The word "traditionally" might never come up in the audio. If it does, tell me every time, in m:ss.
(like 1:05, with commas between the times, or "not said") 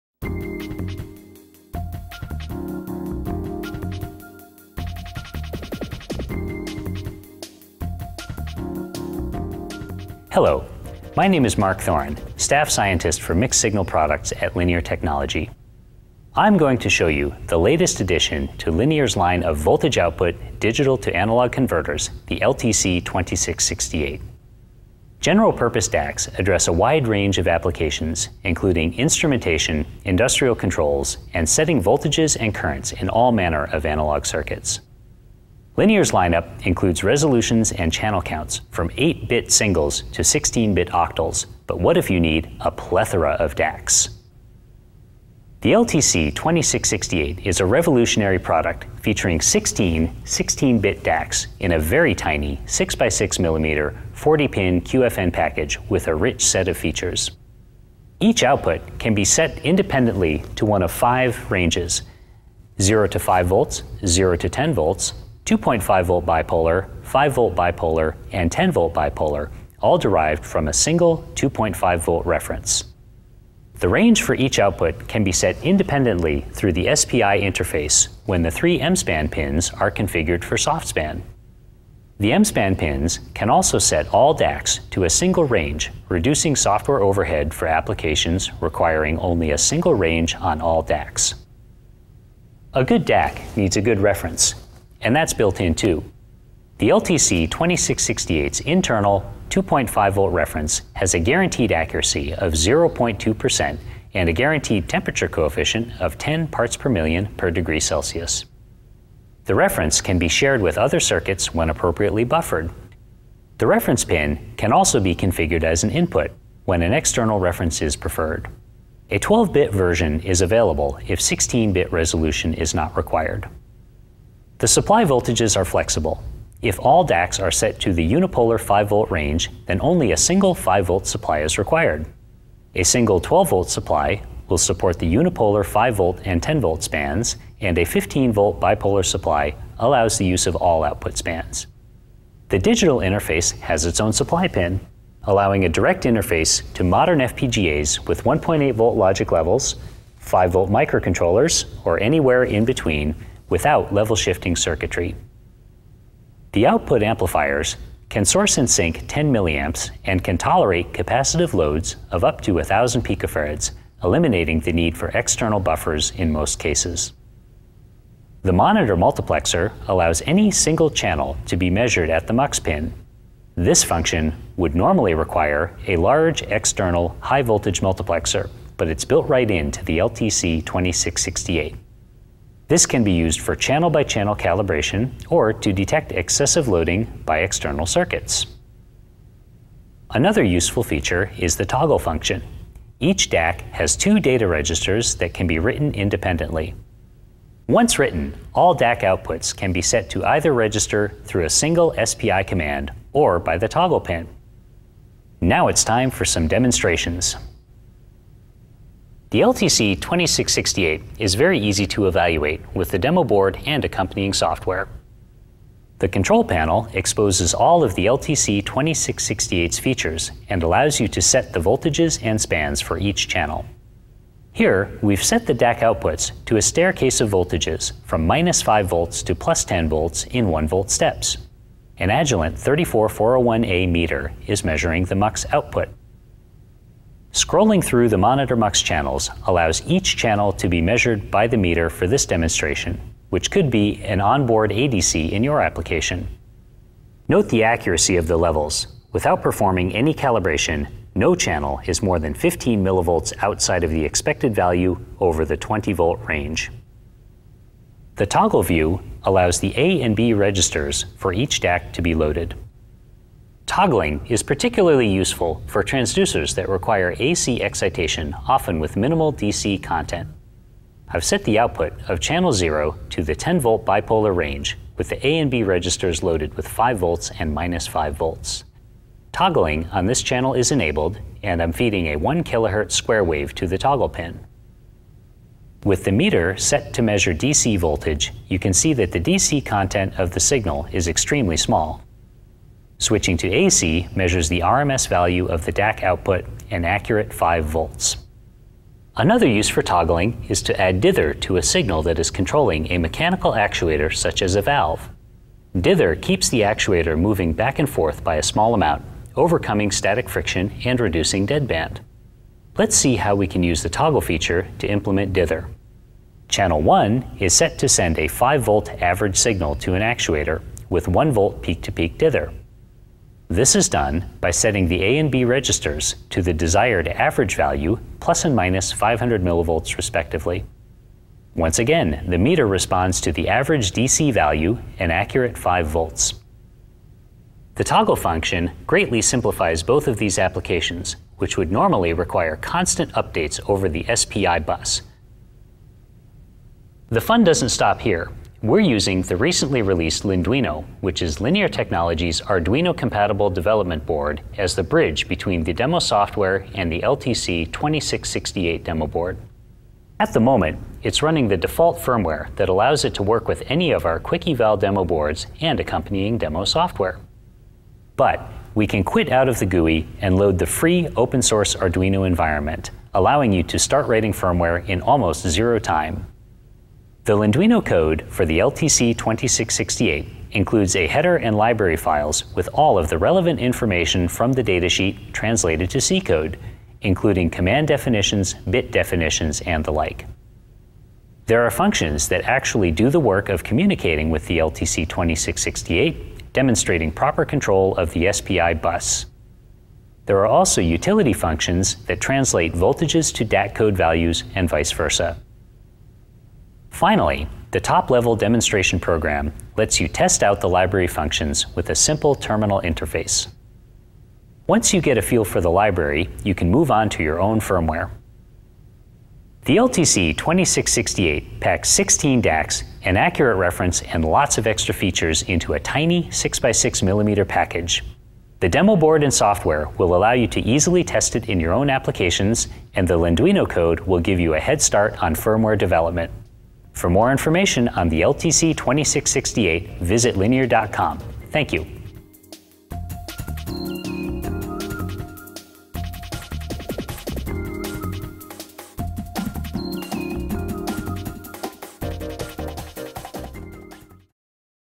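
not said.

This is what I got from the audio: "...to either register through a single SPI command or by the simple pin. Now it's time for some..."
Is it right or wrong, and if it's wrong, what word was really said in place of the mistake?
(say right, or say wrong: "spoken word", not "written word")
wrong: "toggle", not "simple".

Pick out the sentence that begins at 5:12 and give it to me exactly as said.
Let's see how we can use the toggle feature to implement dither.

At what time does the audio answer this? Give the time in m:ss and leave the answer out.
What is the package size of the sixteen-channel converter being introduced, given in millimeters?
0:52.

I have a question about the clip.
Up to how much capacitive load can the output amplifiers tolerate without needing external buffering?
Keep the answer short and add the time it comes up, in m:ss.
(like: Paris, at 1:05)
1,000 picofarads, at 2:42.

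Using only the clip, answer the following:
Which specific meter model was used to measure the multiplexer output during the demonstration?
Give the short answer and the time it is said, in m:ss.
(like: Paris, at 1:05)
Agilent 34401A, at 3:52.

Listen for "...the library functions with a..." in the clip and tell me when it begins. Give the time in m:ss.
6:50.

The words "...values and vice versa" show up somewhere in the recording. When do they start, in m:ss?
6:43.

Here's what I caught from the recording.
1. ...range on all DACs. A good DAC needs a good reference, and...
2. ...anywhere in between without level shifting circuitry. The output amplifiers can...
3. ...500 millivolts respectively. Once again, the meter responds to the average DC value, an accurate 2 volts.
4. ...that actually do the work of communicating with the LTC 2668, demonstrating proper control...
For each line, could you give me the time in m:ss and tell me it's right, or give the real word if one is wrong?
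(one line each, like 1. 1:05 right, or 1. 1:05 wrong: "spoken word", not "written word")
1. 1:29 right
2. 2:31 right
3. 5:28 wrong: "5", not "2"
4. 6:32 right.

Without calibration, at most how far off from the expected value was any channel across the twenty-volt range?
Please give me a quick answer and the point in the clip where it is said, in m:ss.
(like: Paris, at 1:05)
15 millivolts, at 4:12.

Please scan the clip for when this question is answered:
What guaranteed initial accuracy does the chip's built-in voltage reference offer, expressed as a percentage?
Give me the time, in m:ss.
1:42.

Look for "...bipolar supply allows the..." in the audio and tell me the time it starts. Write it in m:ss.
2:18.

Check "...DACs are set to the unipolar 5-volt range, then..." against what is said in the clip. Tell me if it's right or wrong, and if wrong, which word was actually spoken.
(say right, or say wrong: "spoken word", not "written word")
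right.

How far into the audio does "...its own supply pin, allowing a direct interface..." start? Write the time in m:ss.
2:23.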